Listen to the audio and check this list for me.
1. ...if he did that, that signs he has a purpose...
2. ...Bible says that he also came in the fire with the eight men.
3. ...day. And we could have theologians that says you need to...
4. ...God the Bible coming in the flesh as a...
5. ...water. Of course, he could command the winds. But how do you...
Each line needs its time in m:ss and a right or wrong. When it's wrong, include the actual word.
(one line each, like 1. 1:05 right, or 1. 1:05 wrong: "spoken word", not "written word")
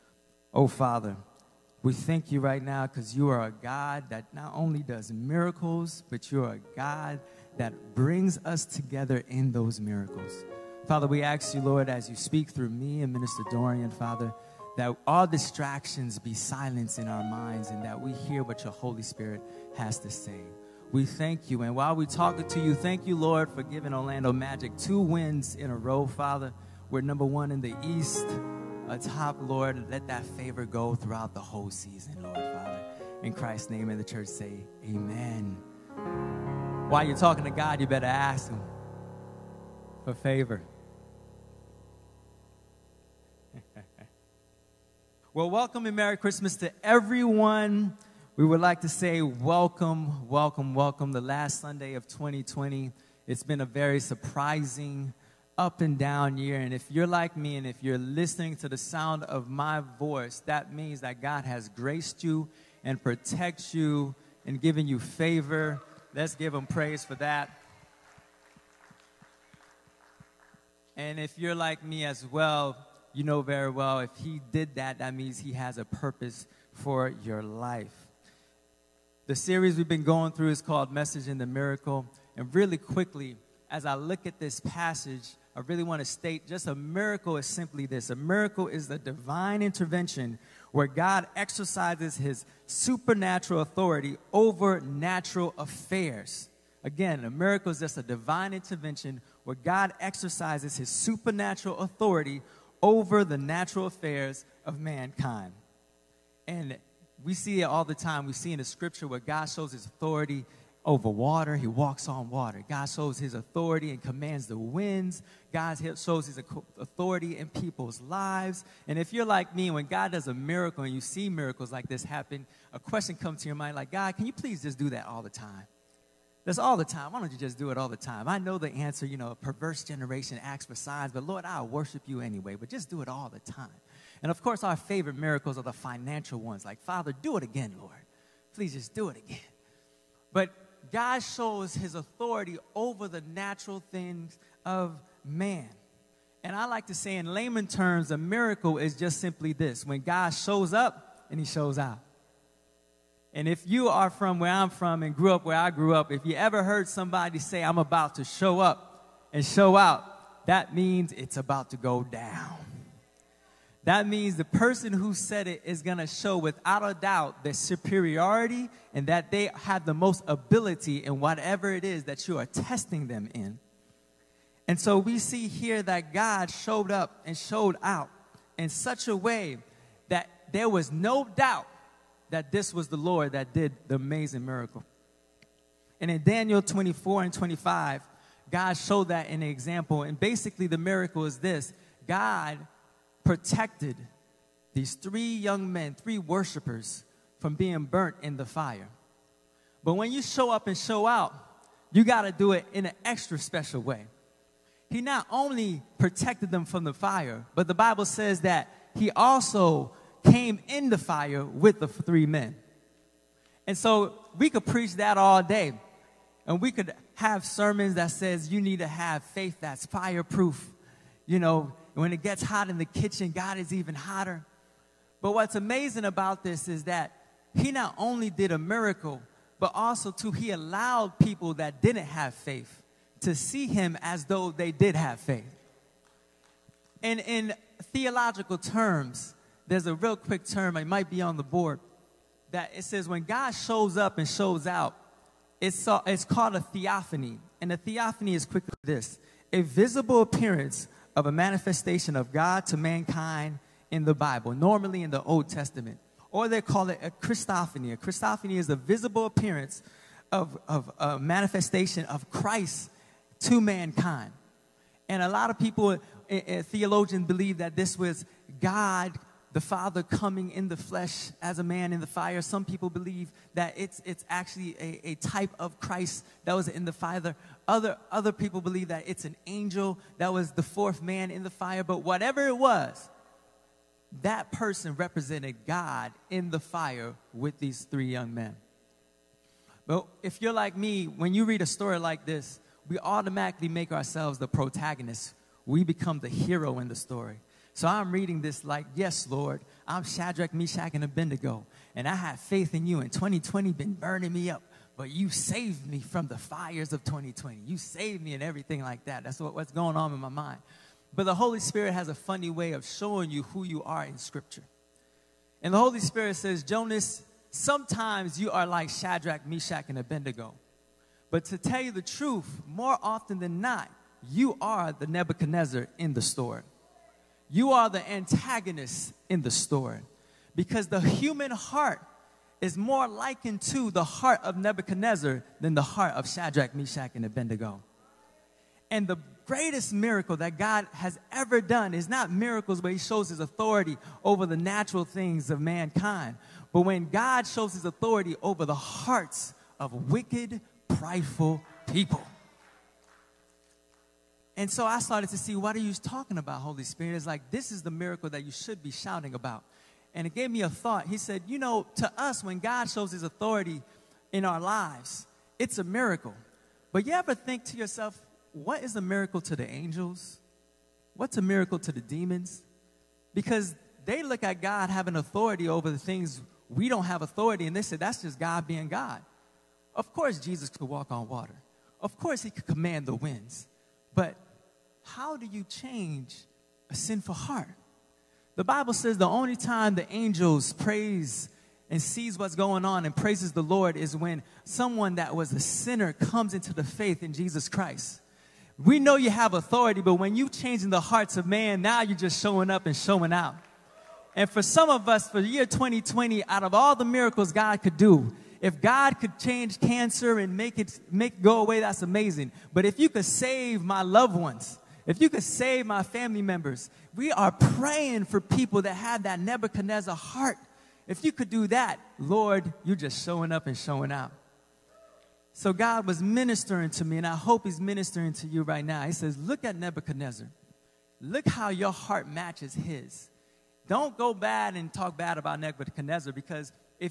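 1. 1:13 wrong: "means", not "signs"
2. 3:27 wrong: "three", not "eight"
3. 3:35 wrong: "sermons", not "theologians"
4. 4:28 wrong: "Father", not "Bible"
5. 6:21 right.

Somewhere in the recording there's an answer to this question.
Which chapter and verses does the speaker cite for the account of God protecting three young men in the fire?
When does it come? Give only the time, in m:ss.
3:06.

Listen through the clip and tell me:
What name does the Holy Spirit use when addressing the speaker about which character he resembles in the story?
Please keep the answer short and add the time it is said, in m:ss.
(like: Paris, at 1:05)
Jonas, at 5:16.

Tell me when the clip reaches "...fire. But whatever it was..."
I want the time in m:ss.
4:41.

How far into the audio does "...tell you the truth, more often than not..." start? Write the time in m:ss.
5:21.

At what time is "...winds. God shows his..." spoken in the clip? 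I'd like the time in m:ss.
1:54.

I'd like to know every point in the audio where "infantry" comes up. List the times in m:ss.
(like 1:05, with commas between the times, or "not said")
not said.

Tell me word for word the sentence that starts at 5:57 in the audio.
It's like, this is the miracle that you should be shouting about.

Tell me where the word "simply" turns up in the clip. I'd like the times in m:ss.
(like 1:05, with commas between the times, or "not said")
1:27, 2:29.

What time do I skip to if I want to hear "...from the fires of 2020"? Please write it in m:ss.
5:05.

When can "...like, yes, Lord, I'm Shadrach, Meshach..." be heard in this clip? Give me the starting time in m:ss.
4:58.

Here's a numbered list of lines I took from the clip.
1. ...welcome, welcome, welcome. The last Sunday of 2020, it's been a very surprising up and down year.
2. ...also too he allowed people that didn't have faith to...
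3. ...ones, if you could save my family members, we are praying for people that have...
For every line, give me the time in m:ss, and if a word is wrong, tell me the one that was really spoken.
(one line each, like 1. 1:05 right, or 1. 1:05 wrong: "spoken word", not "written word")
1. 0:49 right
2. 3:49 right
3. 6:54 right.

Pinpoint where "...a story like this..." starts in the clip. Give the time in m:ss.
4:51.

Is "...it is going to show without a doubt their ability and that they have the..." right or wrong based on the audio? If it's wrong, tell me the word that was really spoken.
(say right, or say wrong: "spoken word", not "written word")
wrong: "superiority", not "ability".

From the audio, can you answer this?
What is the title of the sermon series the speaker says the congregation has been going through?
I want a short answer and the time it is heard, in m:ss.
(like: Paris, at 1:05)
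Message in the Miracle, at 1:20.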